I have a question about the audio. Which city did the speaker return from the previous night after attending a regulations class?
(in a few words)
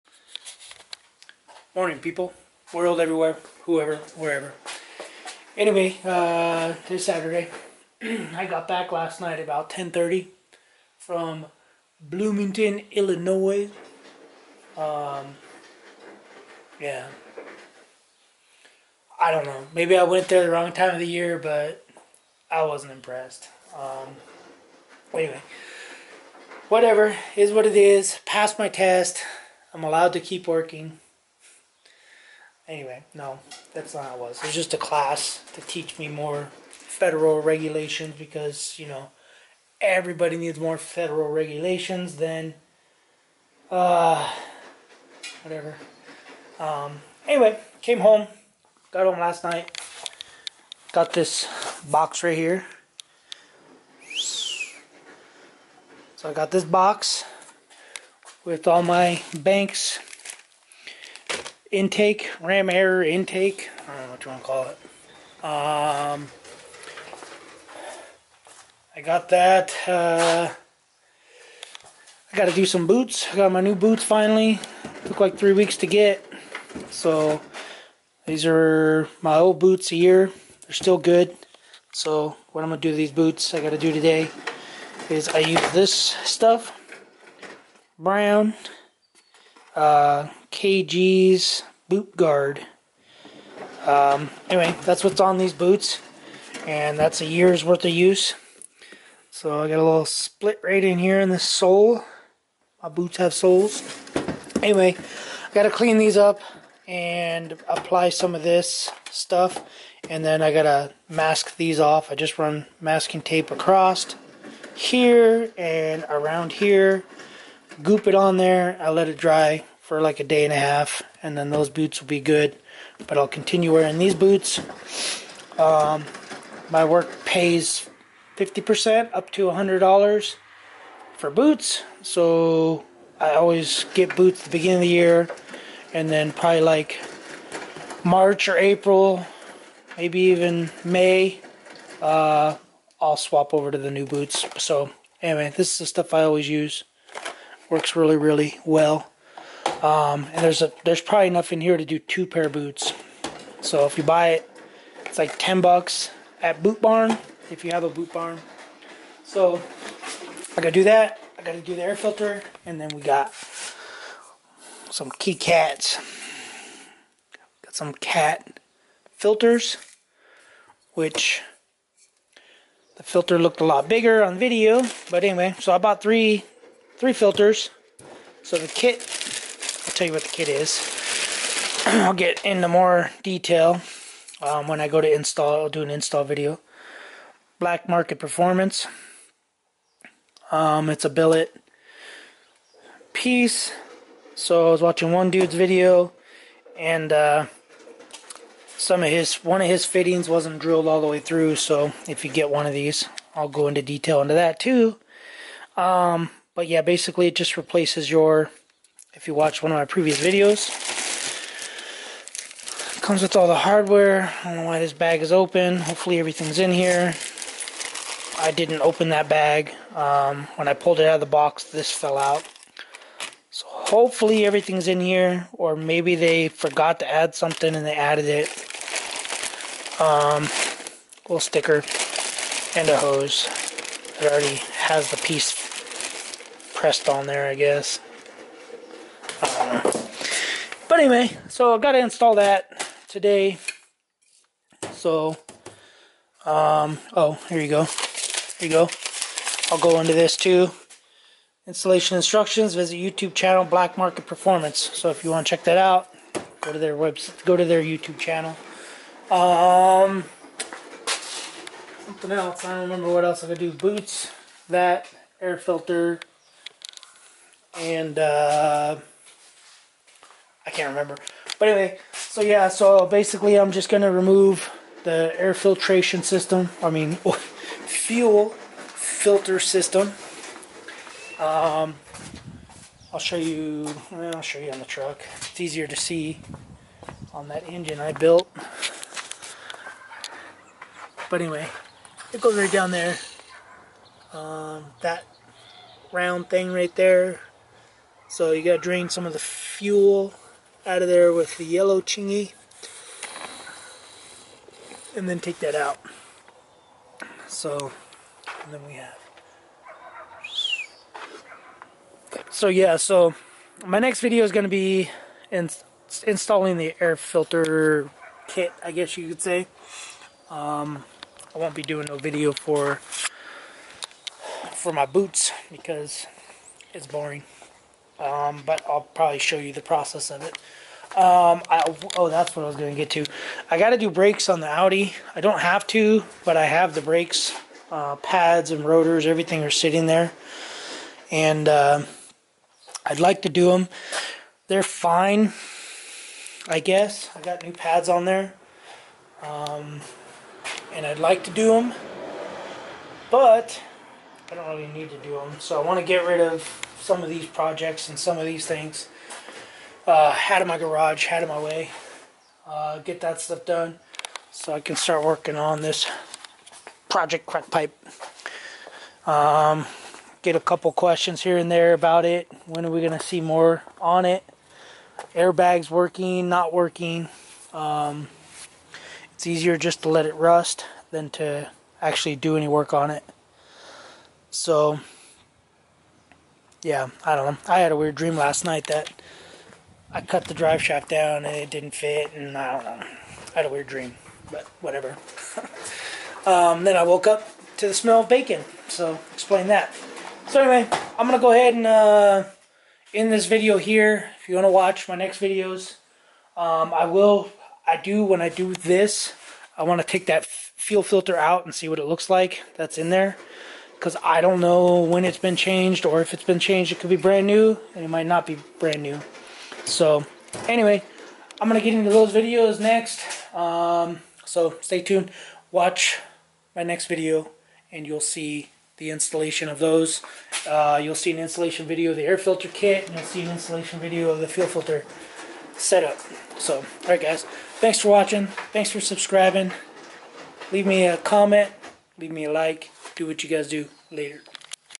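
Bloomington, Illinois.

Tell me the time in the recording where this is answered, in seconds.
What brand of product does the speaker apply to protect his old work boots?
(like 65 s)
90 s.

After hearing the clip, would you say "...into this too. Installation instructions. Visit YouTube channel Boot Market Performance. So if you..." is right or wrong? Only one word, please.
wrong.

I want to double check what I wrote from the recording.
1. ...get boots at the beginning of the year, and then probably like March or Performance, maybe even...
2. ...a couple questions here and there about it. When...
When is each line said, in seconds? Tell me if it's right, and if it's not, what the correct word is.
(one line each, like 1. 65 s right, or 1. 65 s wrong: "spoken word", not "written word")
1. 133 s wrong: "April", not "Performance"
2. 370 s right.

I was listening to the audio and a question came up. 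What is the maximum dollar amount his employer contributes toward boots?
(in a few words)
$100.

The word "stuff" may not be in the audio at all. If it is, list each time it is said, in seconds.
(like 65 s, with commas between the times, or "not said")
85 s, 109 s, 145 s, 363 s.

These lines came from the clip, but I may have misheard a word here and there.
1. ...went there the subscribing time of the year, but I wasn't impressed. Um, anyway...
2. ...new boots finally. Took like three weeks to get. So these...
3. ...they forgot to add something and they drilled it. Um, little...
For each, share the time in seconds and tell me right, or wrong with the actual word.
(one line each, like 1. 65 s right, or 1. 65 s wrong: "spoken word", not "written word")
1. 20 s wrong: "wrong", not "subscribing"
2. 73 s right
3. 226 s wrong: "added", not "drilled".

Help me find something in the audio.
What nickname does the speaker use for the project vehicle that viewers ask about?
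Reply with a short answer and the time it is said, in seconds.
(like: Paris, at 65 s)
crack pipe, at 367 s.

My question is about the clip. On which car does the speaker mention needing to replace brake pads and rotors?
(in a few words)
Audi.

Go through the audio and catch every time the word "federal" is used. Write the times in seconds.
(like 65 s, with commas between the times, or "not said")
36 s, 40 s.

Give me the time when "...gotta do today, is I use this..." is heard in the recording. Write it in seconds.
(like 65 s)
83 s.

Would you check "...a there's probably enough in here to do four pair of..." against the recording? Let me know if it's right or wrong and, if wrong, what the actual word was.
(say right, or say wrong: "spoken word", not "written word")
wrong: "two", not "four".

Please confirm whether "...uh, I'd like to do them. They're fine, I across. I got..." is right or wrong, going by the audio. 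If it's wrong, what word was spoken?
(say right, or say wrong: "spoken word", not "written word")
wrong: "guess", not "across".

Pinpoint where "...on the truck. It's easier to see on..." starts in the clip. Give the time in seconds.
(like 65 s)
284 s.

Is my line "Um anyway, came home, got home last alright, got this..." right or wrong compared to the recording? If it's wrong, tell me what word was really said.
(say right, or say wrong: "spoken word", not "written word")
wrong: "night", not "alright".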